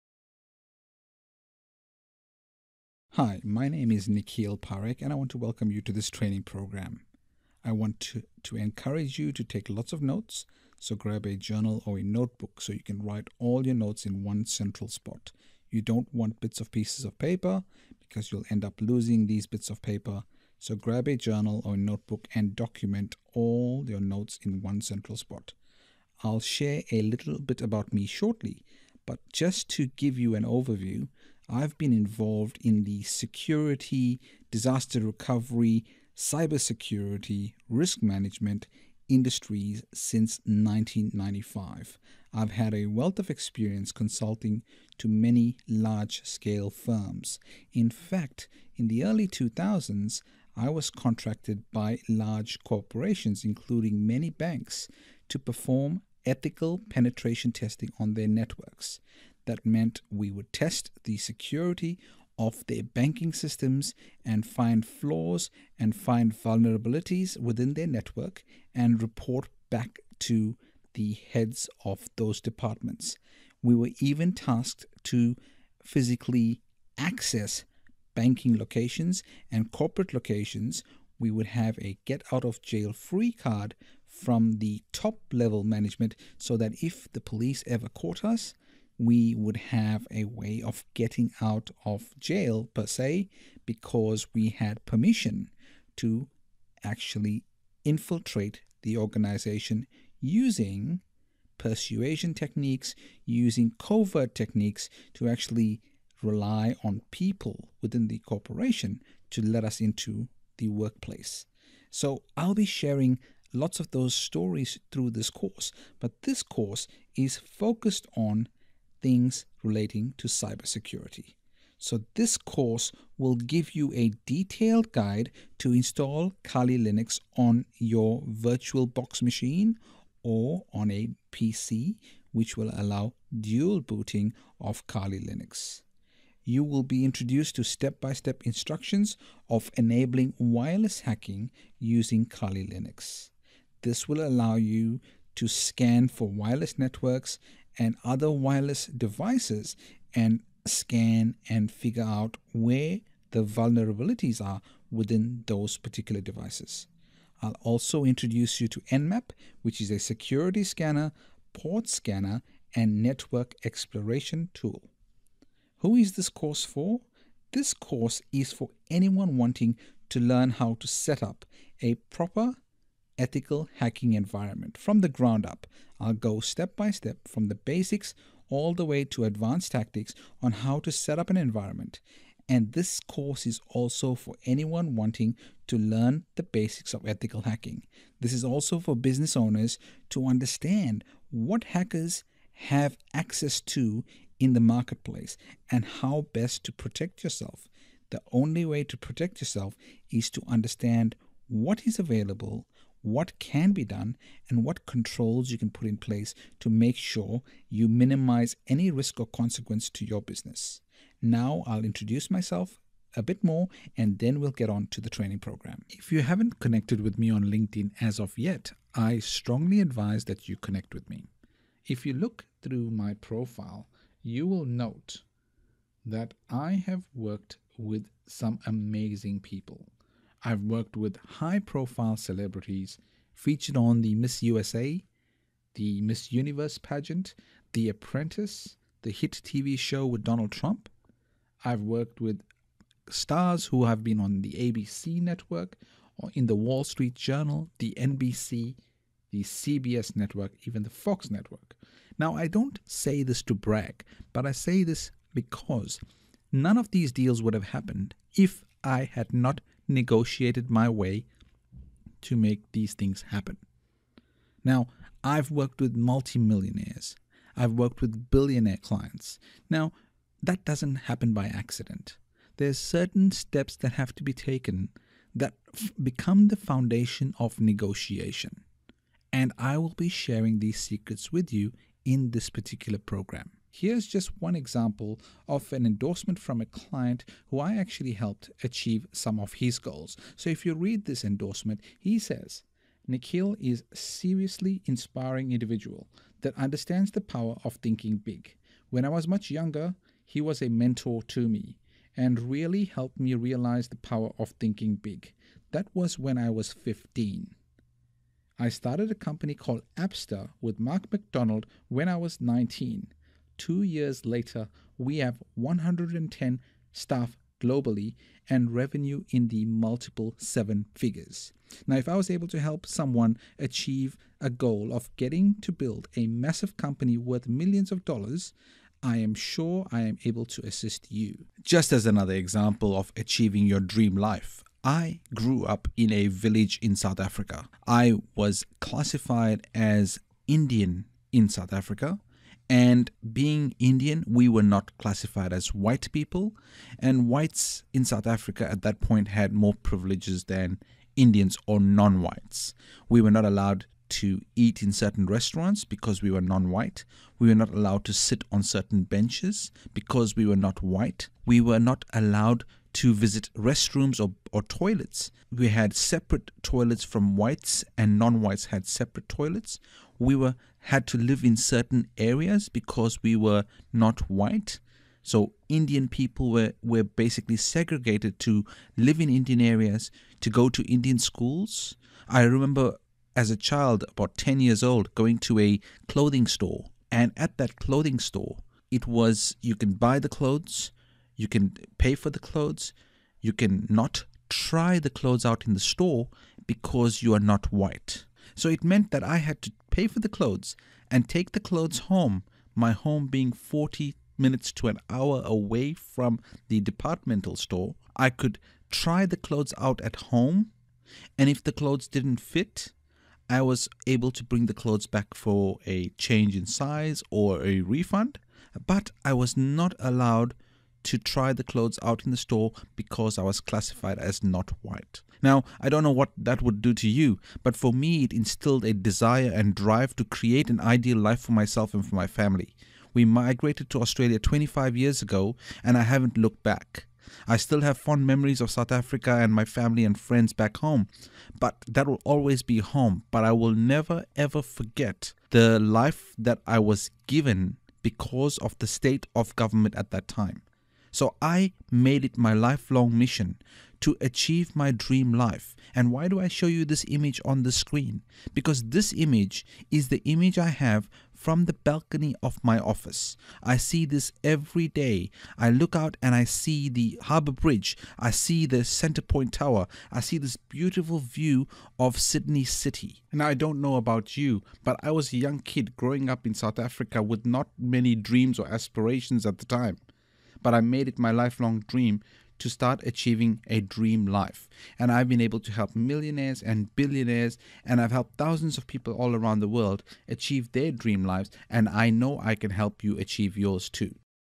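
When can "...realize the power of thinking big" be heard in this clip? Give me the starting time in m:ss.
5:03.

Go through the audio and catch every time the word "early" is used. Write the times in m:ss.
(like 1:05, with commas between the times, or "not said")
0:49.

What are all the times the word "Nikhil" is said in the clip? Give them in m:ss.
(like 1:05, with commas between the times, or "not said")
0:04, 4:53.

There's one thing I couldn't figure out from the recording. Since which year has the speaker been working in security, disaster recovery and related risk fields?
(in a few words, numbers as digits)
1995.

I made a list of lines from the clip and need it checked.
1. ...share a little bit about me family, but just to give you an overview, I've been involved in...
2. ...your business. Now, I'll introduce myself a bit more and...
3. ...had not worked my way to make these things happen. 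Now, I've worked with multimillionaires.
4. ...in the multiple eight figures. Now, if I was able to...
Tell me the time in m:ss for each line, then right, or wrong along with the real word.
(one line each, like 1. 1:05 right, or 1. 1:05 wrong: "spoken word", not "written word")
1. 0:26 wrong: "shortly", not "family"
2. 3:30 right
3. 4:19 wrong: "negotiated", not "worked"
4. 5:19 wrong: "seven", not "eight".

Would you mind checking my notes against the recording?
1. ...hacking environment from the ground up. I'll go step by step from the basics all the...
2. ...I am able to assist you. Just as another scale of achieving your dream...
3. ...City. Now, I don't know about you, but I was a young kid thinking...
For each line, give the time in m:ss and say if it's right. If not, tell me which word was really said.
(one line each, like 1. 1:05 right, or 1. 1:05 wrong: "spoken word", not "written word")
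1. 2:53 right
2. 5:29 wrong: "example", not "scale"
3. 7:52 wrong: "growing", not "thinking".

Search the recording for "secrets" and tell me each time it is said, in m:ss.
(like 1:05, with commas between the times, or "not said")
4:40.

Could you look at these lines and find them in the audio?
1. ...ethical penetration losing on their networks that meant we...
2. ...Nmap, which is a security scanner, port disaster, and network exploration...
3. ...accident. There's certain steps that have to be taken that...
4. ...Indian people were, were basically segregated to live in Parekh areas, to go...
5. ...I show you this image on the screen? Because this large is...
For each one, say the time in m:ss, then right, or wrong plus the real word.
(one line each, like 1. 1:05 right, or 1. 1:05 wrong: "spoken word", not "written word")
1. 0:56 wrong: "testing", not "losing"
2. 2:38 wrong: "scanner", not "disaster"
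3. 4:31 right
4. 6:15 wrong: "Indian", not "Parekh"
5. 7:36 wrong: "image", not "large".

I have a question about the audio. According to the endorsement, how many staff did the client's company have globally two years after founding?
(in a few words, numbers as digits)
110.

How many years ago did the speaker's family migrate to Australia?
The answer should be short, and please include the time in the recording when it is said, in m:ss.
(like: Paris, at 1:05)
25, at 7:14.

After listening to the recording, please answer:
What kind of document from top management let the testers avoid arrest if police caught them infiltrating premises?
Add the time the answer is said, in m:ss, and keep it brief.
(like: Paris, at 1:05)
Get out of jail free card, at 1:22.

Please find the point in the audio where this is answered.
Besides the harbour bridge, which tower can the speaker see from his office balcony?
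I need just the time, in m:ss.
7:48.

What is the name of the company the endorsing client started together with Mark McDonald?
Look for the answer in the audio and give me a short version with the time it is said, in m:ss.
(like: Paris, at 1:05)
Appster, at 5:09.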